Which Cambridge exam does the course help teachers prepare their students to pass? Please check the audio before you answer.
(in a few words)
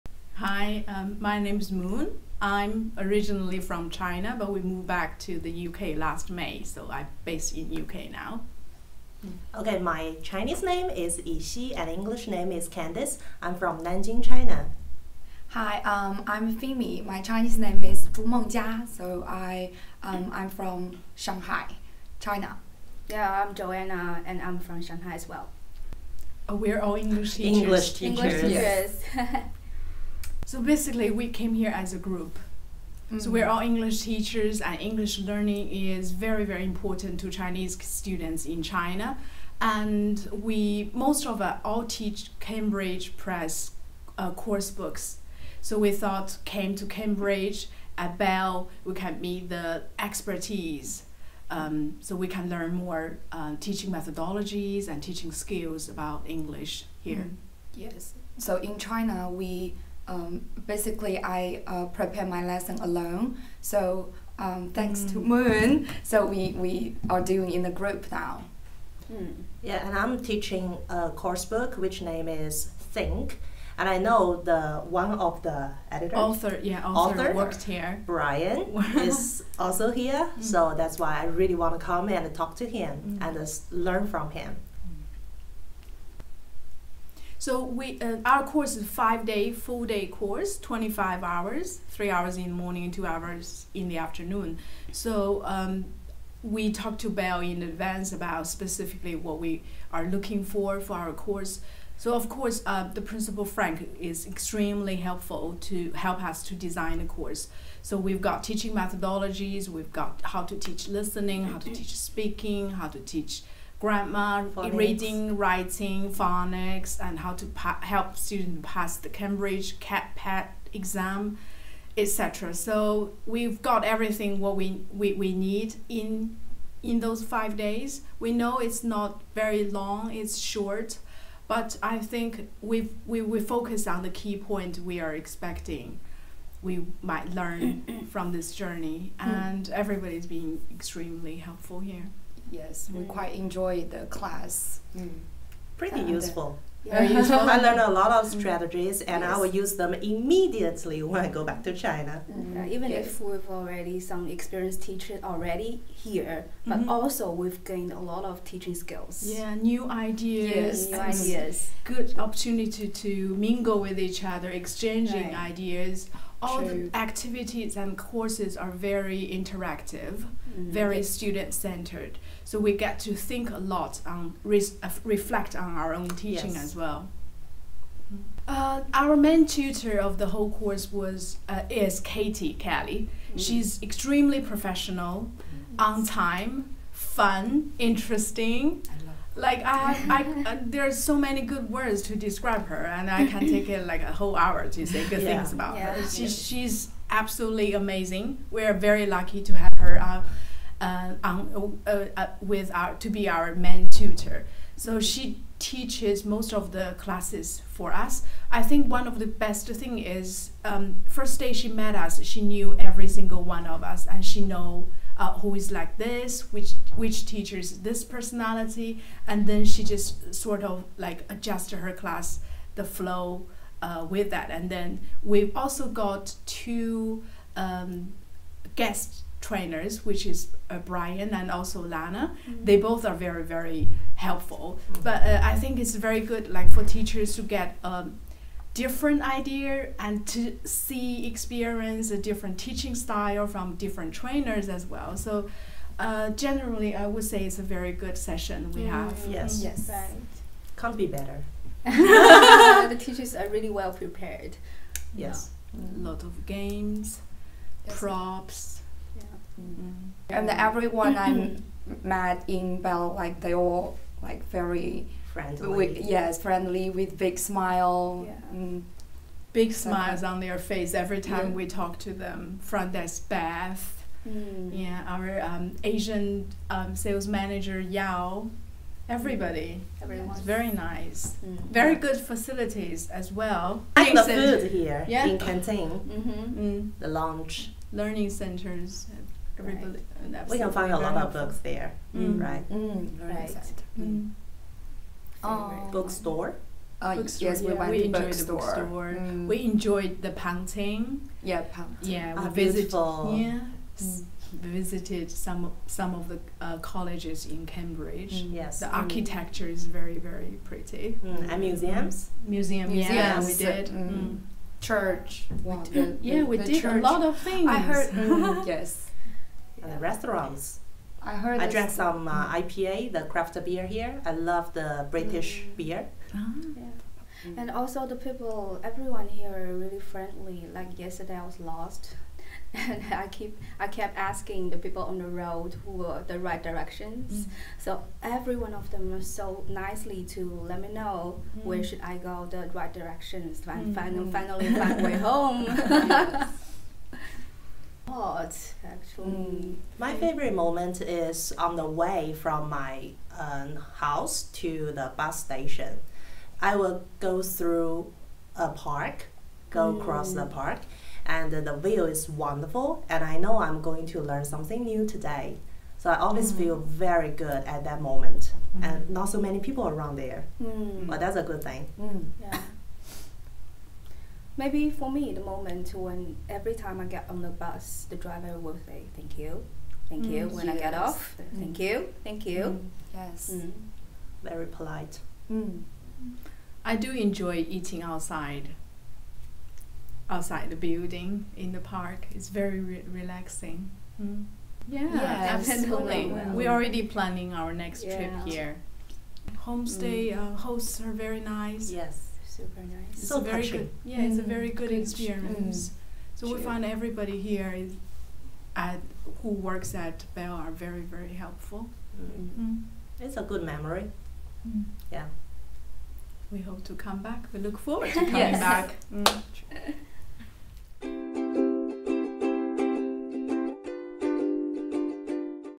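KET.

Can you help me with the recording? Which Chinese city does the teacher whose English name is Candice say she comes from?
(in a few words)
Nanjing.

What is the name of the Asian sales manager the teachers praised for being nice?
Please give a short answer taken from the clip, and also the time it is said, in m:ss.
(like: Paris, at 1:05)
Yao, at 4:37.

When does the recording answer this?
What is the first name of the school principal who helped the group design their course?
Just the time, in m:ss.
1:43.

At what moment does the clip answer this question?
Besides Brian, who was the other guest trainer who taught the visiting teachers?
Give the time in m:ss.
3:51.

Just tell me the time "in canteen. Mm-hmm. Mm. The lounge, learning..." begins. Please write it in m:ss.
4:45.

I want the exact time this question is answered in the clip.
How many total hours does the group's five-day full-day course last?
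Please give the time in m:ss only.
1:30.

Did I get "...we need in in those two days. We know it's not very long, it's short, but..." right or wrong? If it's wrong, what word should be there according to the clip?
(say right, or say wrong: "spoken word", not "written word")
wrong: "five", not "two".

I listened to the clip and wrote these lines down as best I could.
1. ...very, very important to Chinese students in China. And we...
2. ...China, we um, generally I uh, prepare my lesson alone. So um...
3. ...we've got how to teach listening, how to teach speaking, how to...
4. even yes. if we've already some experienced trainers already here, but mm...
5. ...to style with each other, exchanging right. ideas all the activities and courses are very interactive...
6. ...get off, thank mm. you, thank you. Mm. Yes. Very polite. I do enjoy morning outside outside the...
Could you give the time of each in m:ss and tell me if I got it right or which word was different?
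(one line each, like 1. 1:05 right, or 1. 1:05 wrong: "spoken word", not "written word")
1. 0:36 right
2. 0:58 wrong: "basically", not "generally"
3. 1:49 right
4. 2:32 wrong: "teachers", not "trainers"
5. 2:43 wrong: "mingle", not "style"
6. 6:20 wrong: "eating", not "morning".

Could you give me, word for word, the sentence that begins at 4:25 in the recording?
With, yes, friendly with big smile.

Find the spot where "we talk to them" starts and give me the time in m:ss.
4:31.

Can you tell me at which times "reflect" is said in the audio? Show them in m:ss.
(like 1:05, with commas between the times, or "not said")
2:55.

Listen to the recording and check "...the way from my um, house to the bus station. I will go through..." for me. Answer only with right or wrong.
right.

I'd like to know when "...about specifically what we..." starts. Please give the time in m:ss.
1:38.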